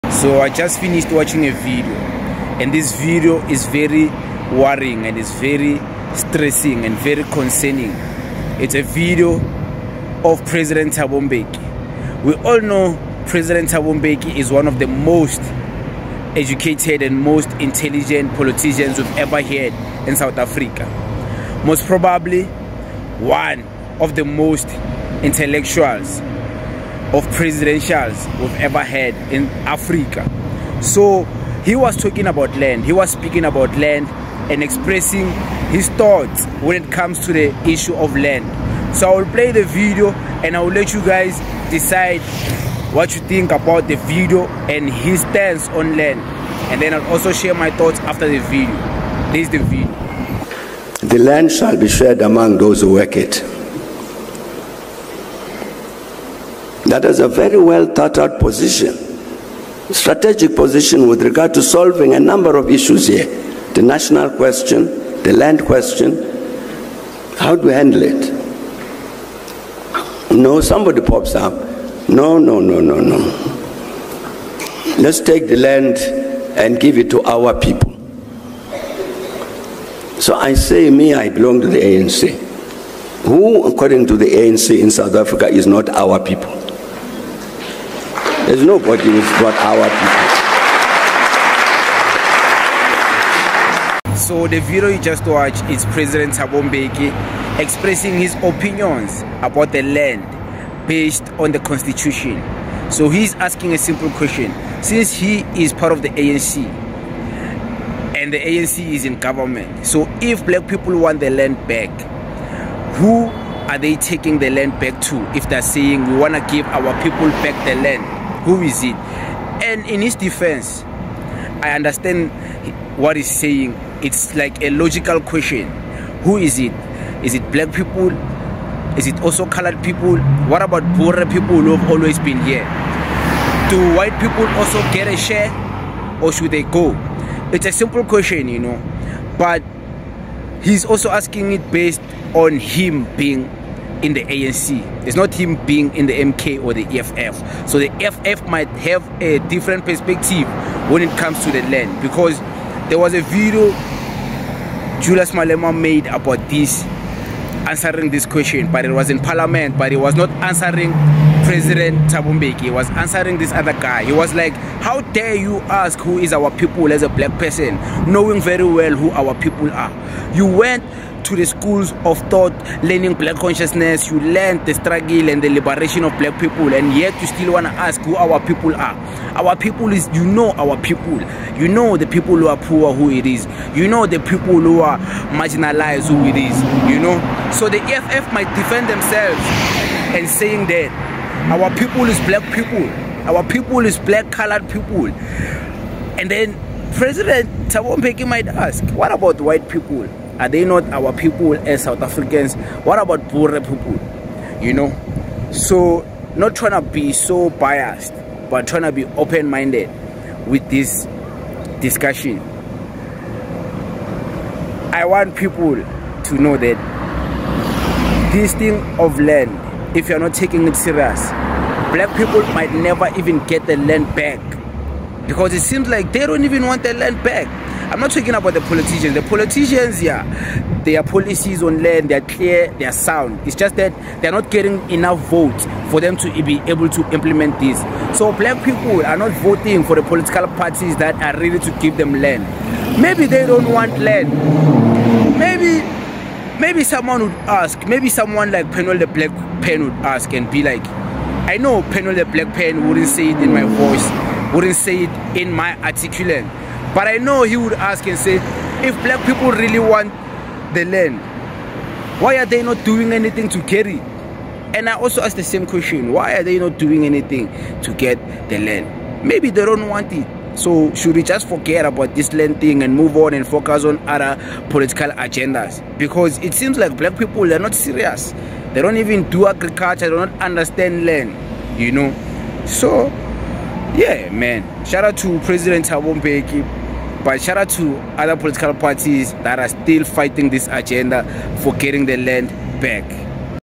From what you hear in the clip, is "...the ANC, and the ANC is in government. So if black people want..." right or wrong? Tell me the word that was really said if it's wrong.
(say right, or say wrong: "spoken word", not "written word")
right.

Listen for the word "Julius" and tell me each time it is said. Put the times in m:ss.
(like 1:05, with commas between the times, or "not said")
2:35.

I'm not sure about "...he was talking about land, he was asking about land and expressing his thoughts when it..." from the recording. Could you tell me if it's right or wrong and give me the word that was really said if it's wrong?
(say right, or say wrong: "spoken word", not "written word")
wrong: "speaking", not "asking".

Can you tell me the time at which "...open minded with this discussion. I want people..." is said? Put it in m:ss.
3:29.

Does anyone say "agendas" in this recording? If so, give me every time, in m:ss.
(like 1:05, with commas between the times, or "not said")
4:35, 4:50.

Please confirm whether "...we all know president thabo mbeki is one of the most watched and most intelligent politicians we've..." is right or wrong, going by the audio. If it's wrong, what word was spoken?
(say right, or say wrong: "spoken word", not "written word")
wrong: "educated", not "watched".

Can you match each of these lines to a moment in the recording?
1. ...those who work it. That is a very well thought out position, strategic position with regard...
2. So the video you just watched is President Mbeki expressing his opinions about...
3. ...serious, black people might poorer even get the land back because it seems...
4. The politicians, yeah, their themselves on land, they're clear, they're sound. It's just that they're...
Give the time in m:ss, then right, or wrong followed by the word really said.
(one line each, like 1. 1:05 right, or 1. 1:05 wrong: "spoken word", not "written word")
1. 0:52 right
2. 1:34 right
3. 3:40 wrong: "never", not "poorer"
4. 3:49 wrong: "policies", not "themselves".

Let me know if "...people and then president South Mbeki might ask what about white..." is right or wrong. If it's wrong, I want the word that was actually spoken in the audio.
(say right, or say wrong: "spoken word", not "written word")
wrong: "Thabo", not "South".